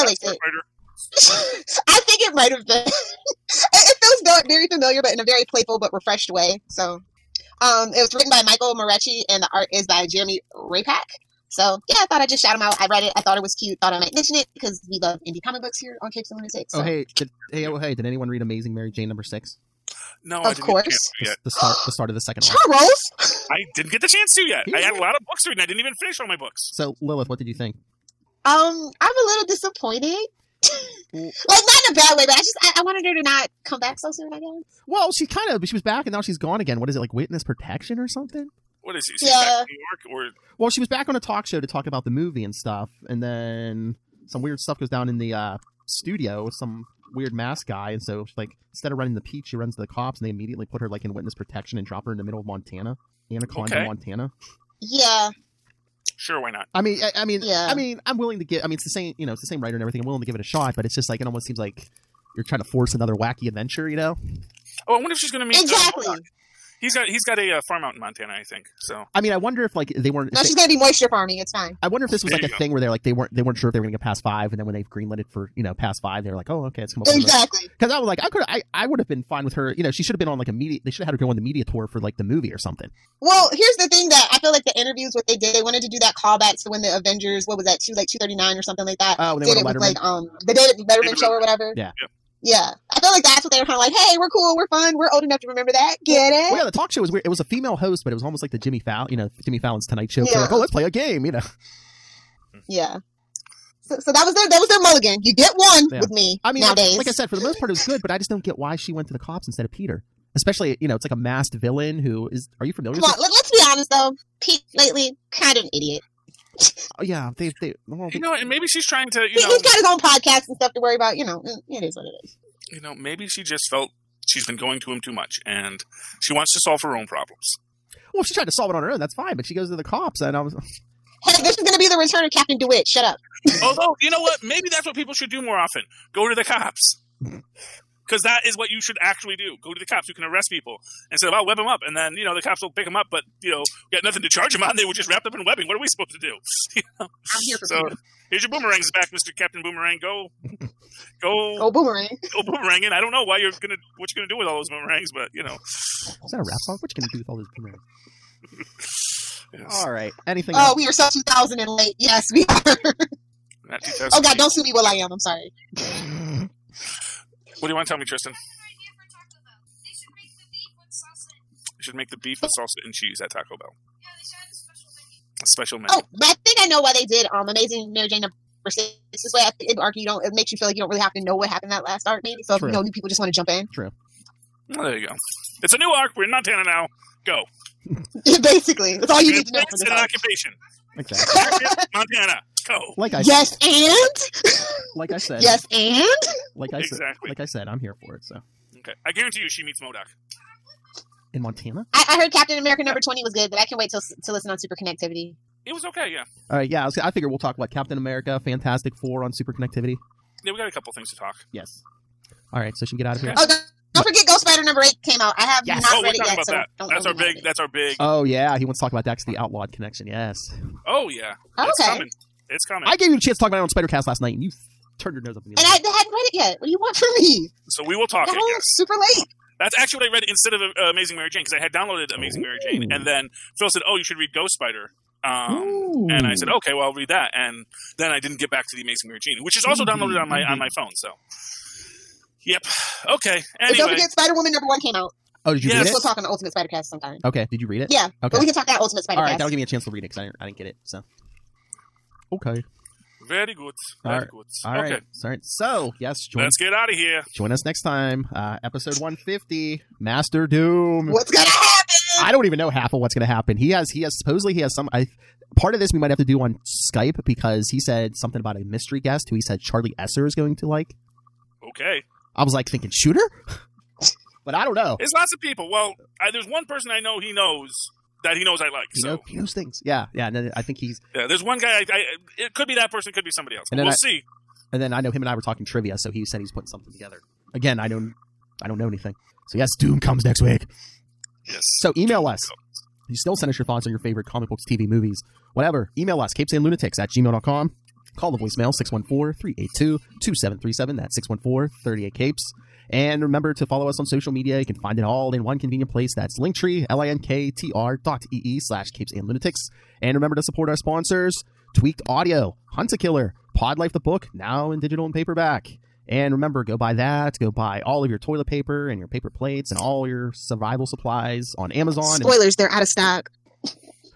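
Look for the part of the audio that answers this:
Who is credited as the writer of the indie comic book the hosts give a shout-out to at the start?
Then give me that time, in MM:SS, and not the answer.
00:08.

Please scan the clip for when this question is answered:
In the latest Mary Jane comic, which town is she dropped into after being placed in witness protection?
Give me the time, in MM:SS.
00:53.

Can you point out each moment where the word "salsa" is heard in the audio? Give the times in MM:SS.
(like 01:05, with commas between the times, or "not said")
02:52.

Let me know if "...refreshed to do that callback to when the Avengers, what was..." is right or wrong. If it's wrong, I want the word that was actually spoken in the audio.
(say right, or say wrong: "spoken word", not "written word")
wrong: "wanted", not "refreshed".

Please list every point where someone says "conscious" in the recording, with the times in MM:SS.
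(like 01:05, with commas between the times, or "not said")
not said.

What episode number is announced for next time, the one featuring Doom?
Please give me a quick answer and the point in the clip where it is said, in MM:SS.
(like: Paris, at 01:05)
150, at 04:18.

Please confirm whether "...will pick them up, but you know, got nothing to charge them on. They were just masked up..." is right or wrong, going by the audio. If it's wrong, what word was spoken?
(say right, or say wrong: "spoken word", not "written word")
wrong: "wrapped", not "masked".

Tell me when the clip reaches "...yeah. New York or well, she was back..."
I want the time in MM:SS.
00:39.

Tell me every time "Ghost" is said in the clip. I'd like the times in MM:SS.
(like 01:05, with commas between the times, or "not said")
03:34, 03:54.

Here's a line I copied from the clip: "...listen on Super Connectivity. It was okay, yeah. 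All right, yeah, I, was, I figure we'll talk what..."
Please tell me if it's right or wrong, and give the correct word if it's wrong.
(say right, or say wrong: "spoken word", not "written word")
right.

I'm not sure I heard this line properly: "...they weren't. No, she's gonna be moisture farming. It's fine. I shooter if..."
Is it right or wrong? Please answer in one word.
wrong.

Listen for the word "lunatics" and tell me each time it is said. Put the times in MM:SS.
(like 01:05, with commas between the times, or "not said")
00:16, 04:56, 05:09.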